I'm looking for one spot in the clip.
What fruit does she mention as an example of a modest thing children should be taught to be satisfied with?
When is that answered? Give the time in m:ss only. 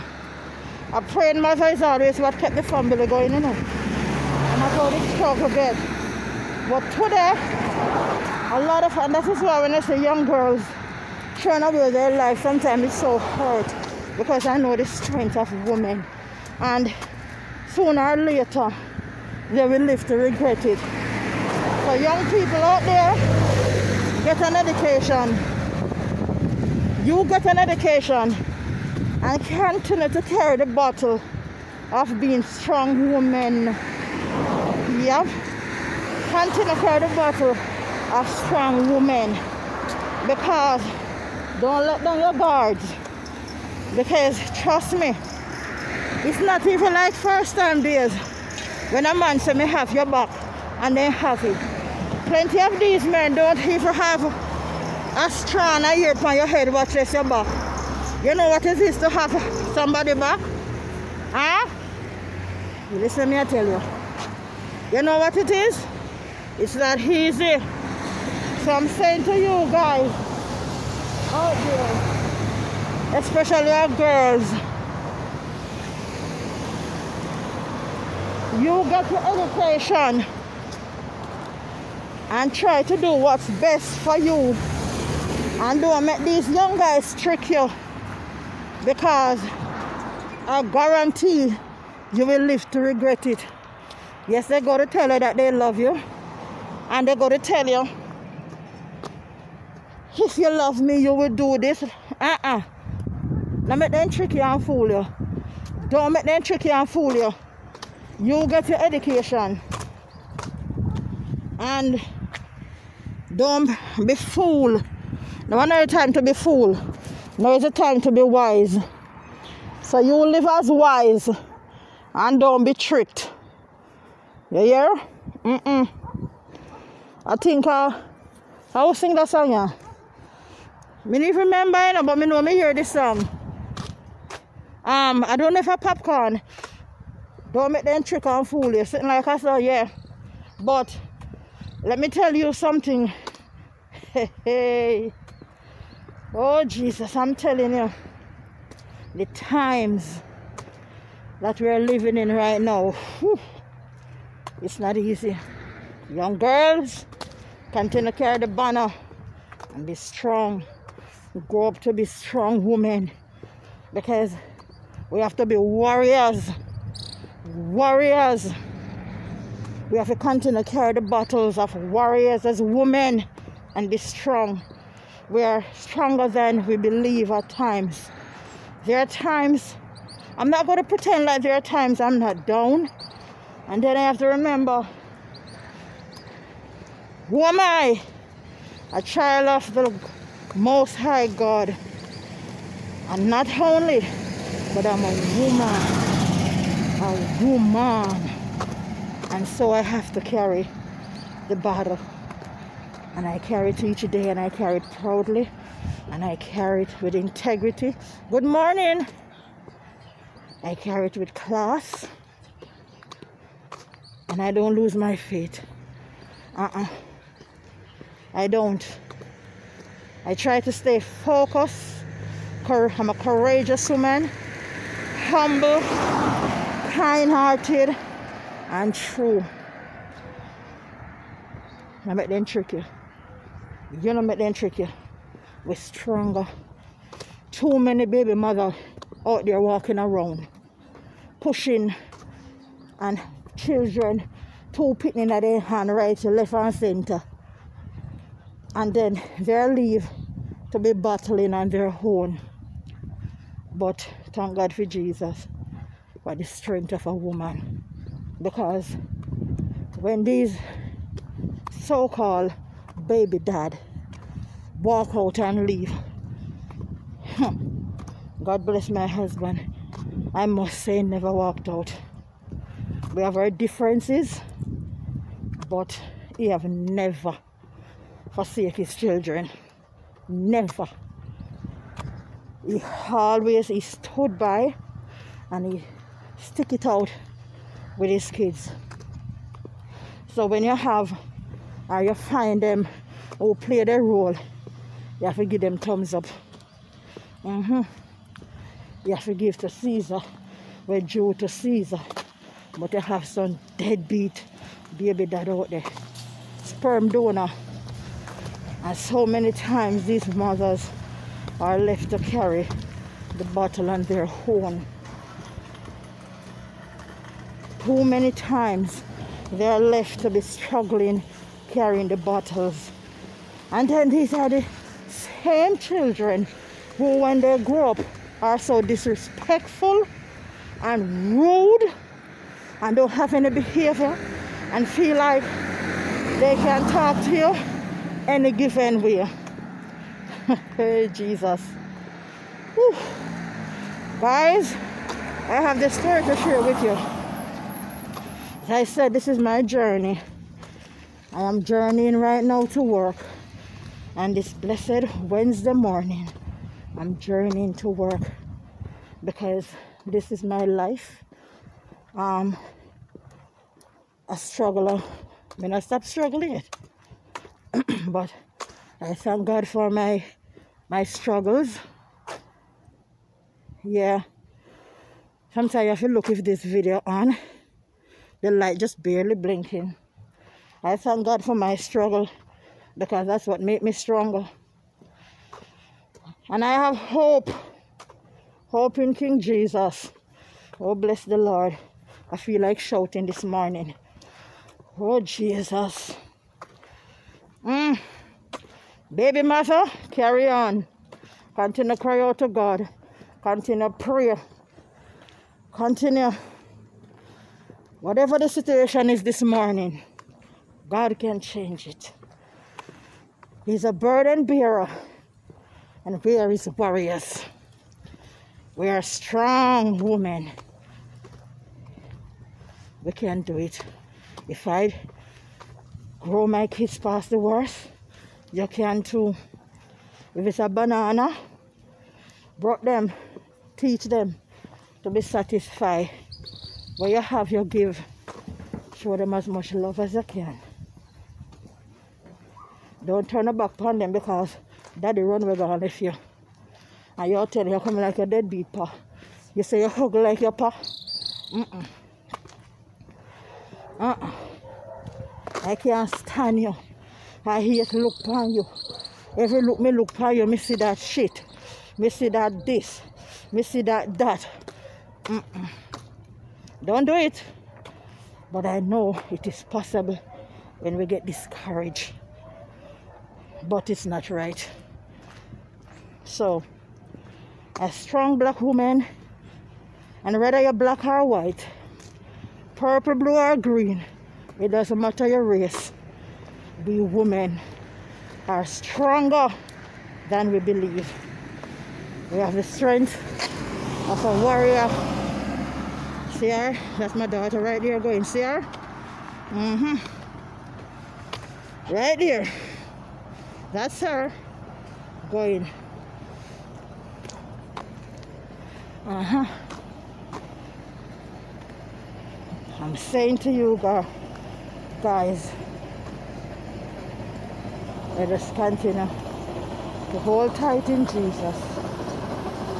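7:10.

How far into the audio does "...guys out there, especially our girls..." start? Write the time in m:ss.
1:09.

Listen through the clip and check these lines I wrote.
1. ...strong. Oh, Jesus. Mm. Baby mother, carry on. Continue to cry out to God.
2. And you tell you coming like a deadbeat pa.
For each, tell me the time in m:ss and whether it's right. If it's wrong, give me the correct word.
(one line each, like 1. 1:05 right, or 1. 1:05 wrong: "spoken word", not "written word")
1. 6:33 wrong: "morning", not "strong"
2. 7:27 right.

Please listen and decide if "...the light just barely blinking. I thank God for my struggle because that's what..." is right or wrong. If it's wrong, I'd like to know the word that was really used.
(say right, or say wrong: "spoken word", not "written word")
right.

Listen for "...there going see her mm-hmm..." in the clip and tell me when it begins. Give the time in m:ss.
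8:17.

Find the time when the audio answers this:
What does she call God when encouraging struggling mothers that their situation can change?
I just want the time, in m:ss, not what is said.
6:53.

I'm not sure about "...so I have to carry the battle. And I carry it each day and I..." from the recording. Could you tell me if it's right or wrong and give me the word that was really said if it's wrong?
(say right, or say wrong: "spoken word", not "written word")
right.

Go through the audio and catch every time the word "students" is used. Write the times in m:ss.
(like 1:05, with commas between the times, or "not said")
not said.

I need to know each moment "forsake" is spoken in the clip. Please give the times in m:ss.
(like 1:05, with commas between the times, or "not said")
4:38.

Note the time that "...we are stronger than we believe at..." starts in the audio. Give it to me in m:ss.
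2:55.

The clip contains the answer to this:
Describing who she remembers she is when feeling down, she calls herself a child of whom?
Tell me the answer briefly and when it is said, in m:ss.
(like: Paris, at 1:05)
the Most High God, at 3:09.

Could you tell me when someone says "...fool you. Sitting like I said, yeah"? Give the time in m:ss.
2:18.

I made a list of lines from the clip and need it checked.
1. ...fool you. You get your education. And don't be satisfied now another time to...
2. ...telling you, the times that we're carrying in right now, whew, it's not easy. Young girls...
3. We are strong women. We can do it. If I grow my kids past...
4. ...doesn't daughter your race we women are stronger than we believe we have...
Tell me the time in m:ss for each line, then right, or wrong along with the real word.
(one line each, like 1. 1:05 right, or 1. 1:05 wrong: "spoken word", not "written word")
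1. 1:46 wrong: "fooled", not "satisfied"
2. 2:27 wrong: "living", not "carrying"
3. 6:58 right
4. 8:04 wrong: "matter", not "daughter".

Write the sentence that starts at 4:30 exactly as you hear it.
I must say, never walked out.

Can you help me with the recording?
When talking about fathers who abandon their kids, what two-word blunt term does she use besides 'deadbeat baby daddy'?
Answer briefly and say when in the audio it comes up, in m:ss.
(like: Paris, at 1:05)
Sperm donor, at 5:06.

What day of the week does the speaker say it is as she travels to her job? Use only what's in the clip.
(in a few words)
Wednesday.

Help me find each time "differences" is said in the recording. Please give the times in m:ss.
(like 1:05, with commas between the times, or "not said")
4:33.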